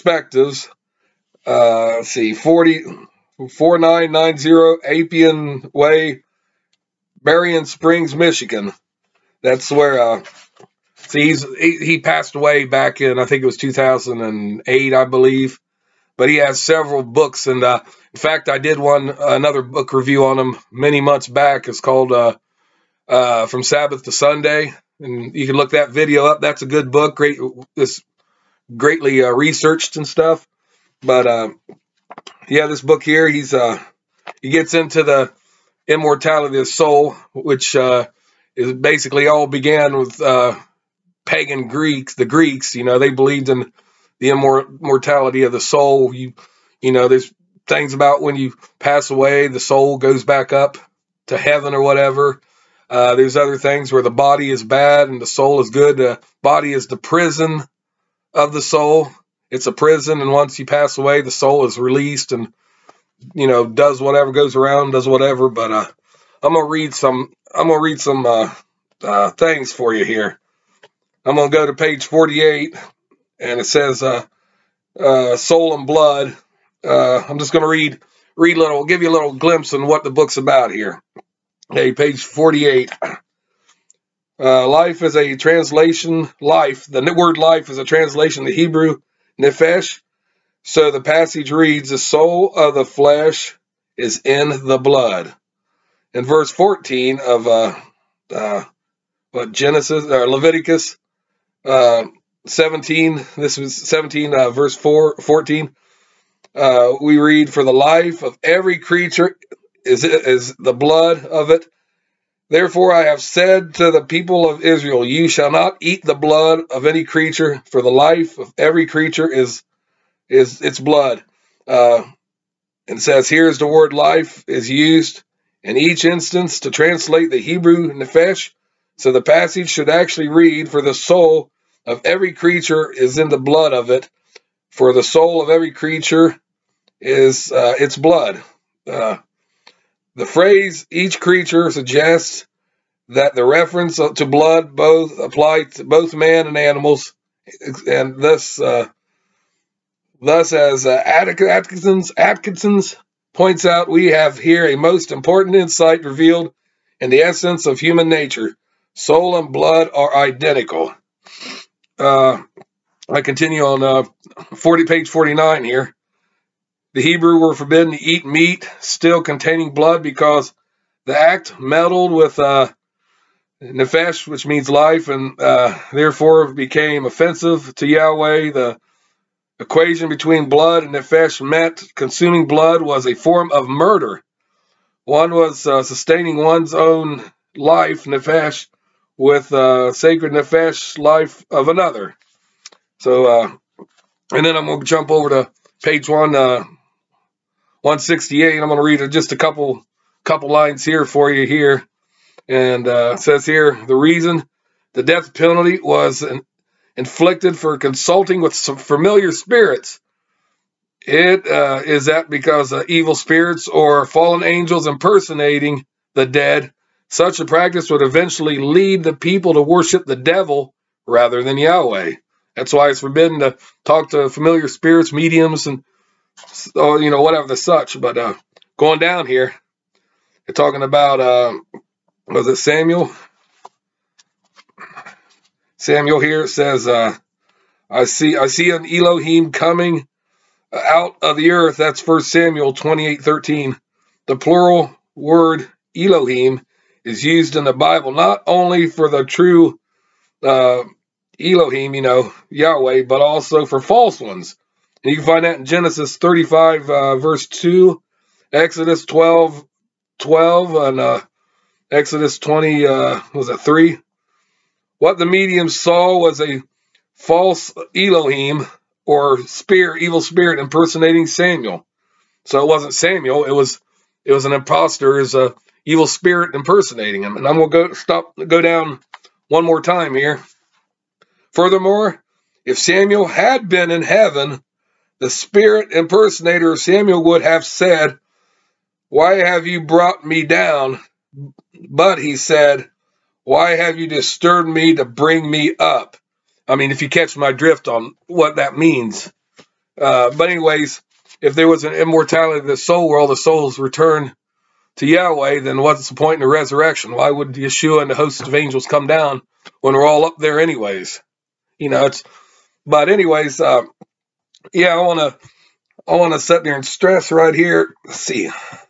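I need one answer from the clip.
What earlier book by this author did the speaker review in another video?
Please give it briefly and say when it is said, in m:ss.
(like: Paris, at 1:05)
From Sabbath to Sunday, at 0:23.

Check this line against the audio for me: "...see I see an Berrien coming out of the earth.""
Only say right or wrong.
wrong.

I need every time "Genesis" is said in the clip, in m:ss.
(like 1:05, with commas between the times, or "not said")
1:39, 4:15.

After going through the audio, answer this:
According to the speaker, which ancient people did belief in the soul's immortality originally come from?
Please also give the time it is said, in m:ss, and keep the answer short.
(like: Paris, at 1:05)
Pagan Greeks, at 0:41.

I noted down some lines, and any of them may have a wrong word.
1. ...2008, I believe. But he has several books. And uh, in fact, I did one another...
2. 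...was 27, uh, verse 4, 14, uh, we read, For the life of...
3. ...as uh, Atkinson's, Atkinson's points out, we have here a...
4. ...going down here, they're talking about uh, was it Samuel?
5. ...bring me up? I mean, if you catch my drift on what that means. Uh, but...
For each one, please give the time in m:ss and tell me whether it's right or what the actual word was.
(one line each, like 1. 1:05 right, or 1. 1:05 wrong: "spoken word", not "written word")
1. 0:13 right
2. 1:43 wrong: "17", not "27"
3. 2:30 right
4. 3:48 right
5. 4:55 right.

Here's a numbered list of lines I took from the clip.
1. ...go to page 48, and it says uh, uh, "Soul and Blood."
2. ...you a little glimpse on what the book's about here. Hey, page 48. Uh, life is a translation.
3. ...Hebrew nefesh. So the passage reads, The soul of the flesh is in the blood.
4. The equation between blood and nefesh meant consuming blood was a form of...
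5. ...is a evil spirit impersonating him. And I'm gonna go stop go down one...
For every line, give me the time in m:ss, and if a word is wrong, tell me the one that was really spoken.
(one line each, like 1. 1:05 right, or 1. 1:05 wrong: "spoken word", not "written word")
1. 1:11 right
2. 1:19 right
3. 1:28 right
4. 2:58 right
5. 4:35 right.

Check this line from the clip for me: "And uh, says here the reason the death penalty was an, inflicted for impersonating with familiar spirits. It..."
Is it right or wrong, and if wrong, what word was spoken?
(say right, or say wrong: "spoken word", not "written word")
wrong: "consulting", not "impersonating".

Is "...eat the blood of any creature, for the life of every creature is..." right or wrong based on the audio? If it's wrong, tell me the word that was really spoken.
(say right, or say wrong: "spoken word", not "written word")
right.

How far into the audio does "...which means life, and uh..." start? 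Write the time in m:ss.
2:54.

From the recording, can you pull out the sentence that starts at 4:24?
What the medium saw was a false Elohim or spirit, evil spirit impersonating Samuel.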